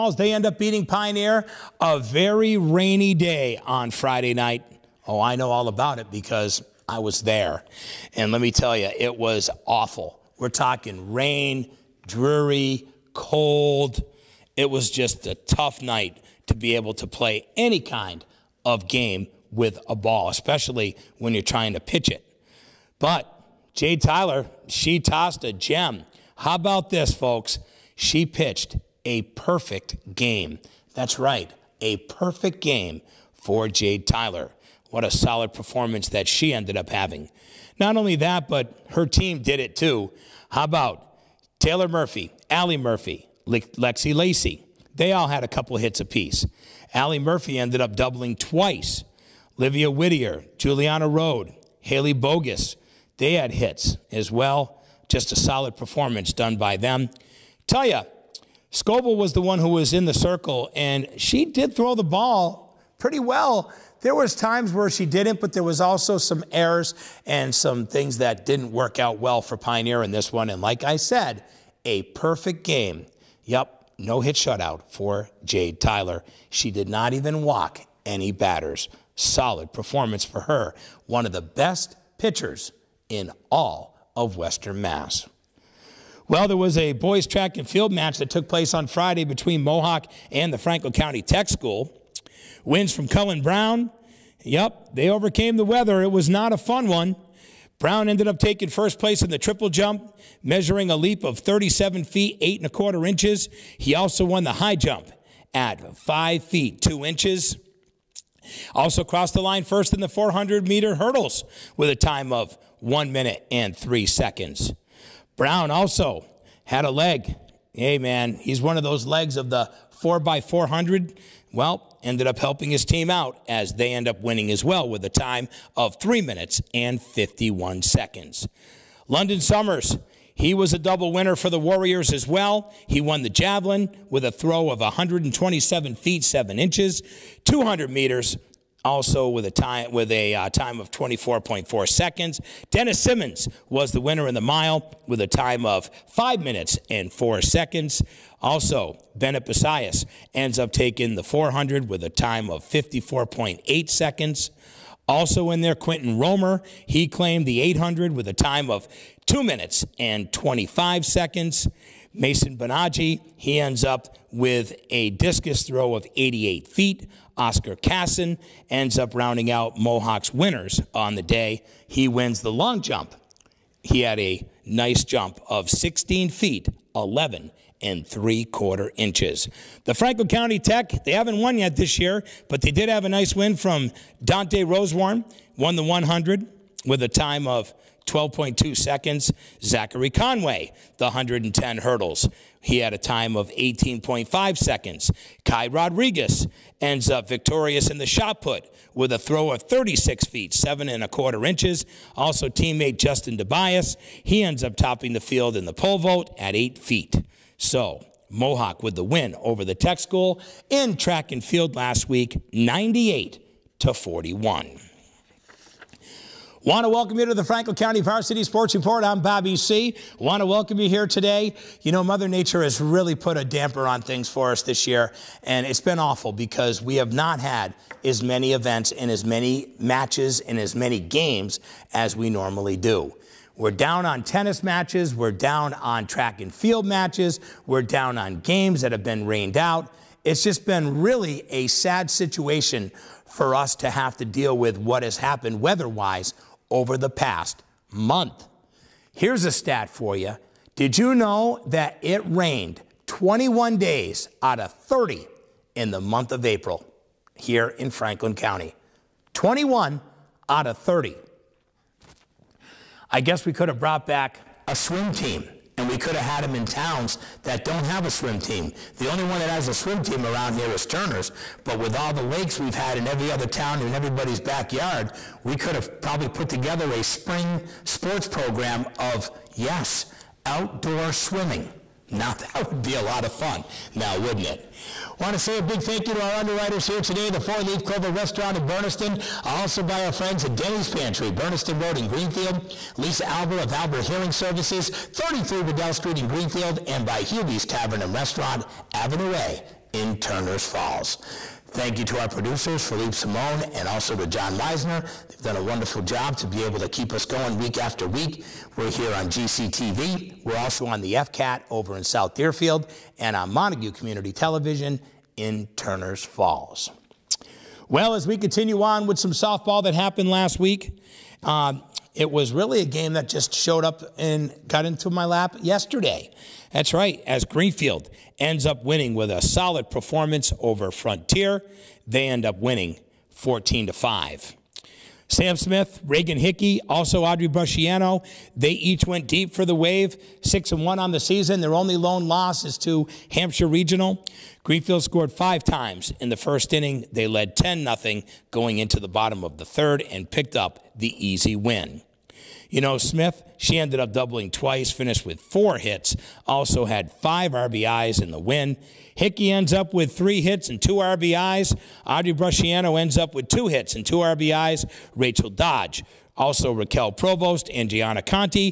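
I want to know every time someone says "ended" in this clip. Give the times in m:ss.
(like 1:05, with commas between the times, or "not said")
0:36, 0:47, 1:38, 2:02, 5:53.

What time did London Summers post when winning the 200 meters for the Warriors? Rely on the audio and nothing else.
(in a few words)
24.4 seconds.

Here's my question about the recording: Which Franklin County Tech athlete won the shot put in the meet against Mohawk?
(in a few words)
Kai Rodriguez.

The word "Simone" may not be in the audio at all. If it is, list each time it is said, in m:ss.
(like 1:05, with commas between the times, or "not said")
5:03.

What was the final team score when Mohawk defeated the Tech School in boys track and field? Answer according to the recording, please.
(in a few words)
98 to 41.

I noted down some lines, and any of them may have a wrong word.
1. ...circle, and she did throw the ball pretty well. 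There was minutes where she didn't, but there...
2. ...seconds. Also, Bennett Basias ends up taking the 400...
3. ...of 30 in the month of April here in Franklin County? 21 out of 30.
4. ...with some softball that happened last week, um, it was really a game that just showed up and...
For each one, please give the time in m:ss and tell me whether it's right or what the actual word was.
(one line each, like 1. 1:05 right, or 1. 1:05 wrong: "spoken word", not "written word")
1. 1:00 wrong: "times", not "minutes"
2. 2:27 right
3. 4:14 right
4. 5:19 right.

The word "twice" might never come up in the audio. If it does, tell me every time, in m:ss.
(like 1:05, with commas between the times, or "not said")
0:48, 5:54.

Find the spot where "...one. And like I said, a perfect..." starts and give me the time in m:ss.
1:10.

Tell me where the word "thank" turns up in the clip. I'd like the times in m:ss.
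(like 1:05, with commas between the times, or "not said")
4:45, 5:01.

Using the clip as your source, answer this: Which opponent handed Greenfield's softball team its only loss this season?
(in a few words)
Hampshire Regional.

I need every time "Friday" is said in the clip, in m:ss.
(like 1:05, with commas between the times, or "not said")
0:03, 1:28.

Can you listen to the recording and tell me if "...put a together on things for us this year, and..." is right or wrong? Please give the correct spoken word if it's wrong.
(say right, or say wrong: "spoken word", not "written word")
wrong: "damper", not "together".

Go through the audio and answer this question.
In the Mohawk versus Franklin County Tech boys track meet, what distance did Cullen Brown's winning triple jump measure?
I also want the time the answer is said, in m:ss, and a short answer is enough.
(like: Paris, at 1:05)
37 feet, 8 1/4 inches, at 1:41.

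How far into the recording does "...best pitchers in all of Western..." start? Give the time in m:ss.
1:21.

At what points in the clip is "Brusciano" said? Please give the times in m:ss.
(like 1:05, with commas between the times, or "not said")
5:37, 6:02.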